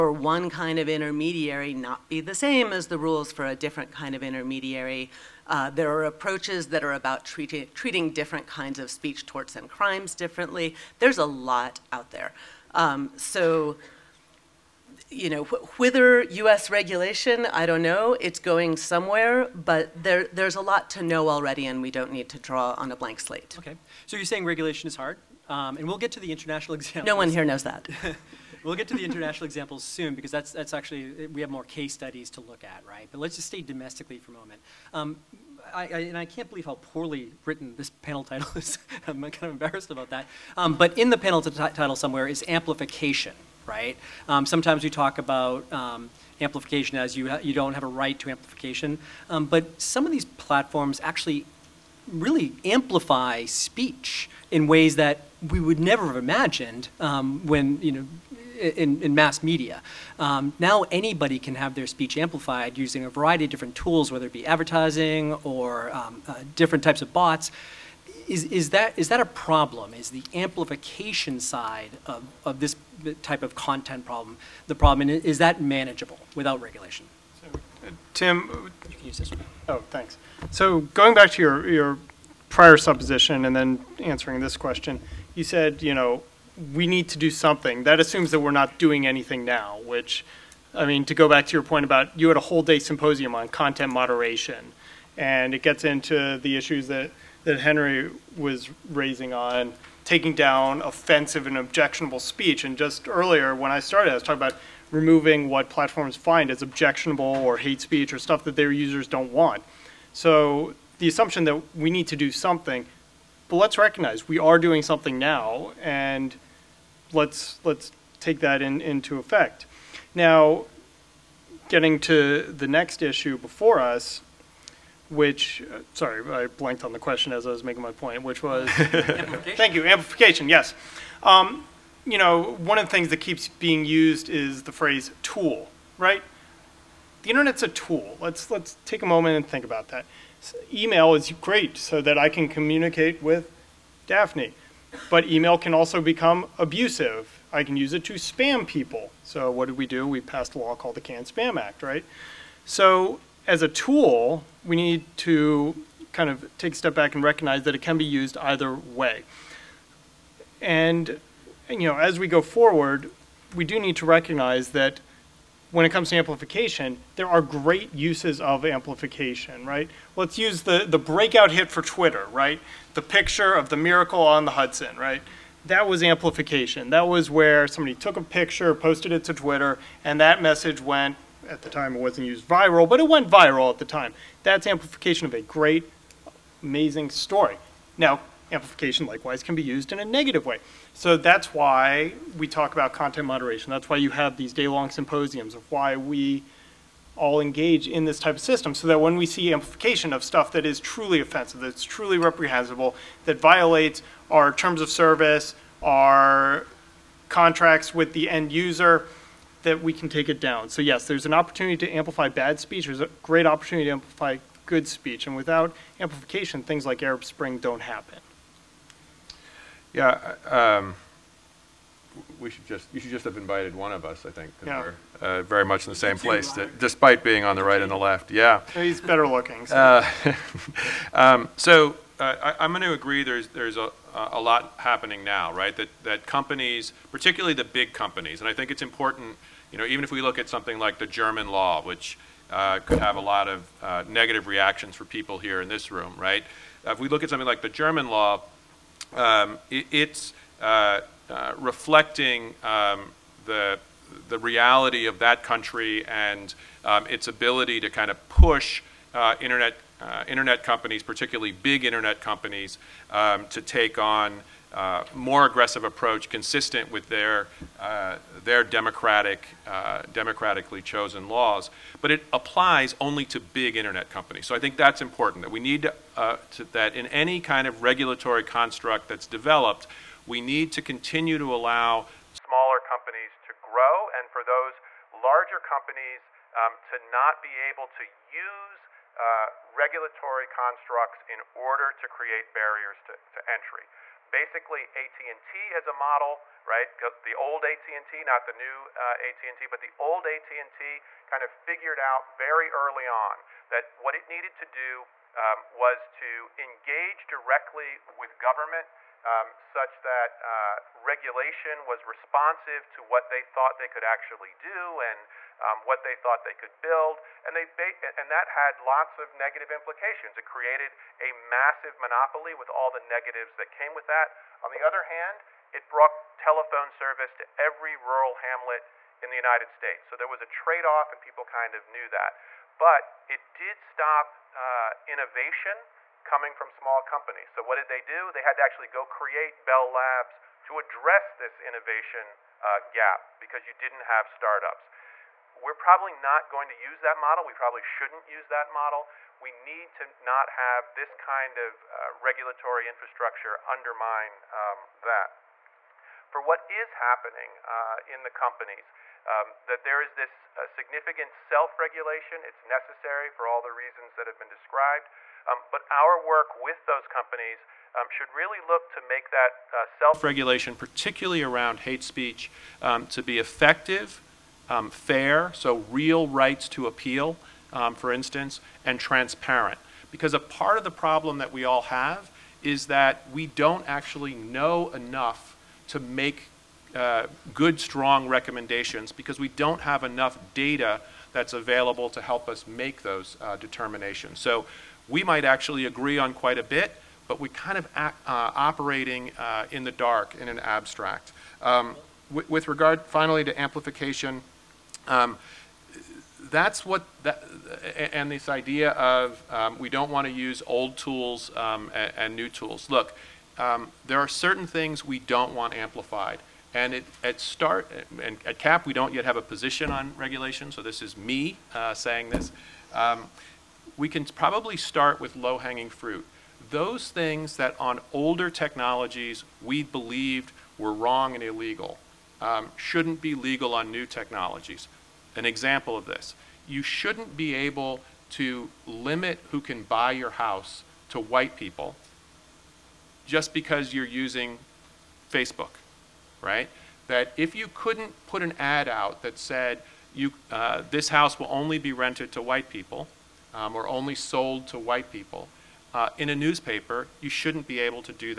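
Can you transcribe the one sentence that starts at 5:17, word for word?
And, they and that had lots of negative implications.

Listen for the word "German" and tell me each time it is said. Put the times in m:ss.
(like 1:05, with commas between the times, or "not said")
4:01, 4:07.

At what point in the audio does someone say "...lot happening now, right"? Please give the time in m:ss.
3:54.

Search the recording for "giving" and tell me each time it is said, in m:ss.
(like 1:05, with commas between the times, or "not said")
not said.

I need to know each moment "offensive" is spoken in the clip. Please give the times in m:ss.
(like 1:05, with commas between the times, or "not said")
1:40, 3:21.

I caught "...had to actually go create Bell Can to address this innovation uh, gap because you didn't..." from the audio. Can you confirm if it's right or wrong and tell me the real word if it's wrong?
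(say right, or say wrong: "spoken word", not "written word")
wrong: "Labs", not "Can".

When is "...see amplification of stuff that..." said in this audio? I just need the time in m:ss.
3:19.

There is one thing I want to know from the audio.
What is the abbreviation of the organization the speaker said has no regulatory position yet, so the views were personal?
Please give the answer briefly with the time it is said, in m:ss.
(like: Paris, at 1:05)
CAP, at 6:58.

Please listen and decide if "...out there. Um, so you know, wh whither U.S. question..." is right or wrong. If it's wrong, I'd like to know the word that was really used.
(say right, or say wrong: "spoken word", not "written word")
wrong: "regulation", not "question".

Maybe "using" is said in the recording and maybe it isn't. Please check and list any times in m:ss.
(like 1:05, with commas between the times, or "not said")
1:02, 7:24.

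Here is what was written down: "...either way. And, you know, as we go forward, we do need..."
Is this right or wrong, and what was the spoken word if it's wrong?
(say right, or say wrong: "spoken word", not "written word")
right.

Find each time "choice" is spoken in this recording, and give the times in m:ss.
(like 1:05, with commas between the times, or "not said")
not said.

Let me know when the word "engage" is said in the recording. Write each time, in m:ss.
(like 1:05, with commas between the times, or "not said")
3:17, 5:06.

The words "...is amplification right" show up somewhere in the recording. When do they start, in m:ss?
0:42.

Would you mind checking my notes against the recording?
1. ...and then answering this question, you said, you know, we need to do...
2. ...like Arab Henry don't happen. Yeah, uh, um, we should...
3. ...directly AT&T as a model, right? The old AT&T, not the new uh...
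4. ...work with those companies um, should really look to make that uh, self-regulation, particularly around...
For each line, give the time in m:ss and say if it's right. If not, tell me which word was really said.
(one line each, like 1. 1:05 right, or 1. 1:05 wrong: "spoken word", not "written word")
1. 1:23 right
2. 3:36 wrong: "Spring", not "Henry"
3. 4:54 wrong: "basically", not "directly"
4. 6:06 right.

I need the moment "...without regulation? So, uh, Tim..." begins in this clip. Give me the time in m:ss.
1:16.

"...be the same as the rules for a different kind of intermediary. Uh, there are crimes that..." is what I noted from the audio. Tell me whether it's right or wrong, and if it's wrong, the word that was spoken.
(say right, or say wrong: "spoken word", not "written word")
wrong: "approaches", not "crimes".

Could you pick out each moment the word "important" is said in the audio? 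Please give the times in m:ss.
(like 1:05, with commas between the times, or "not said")
3:58, 4:35.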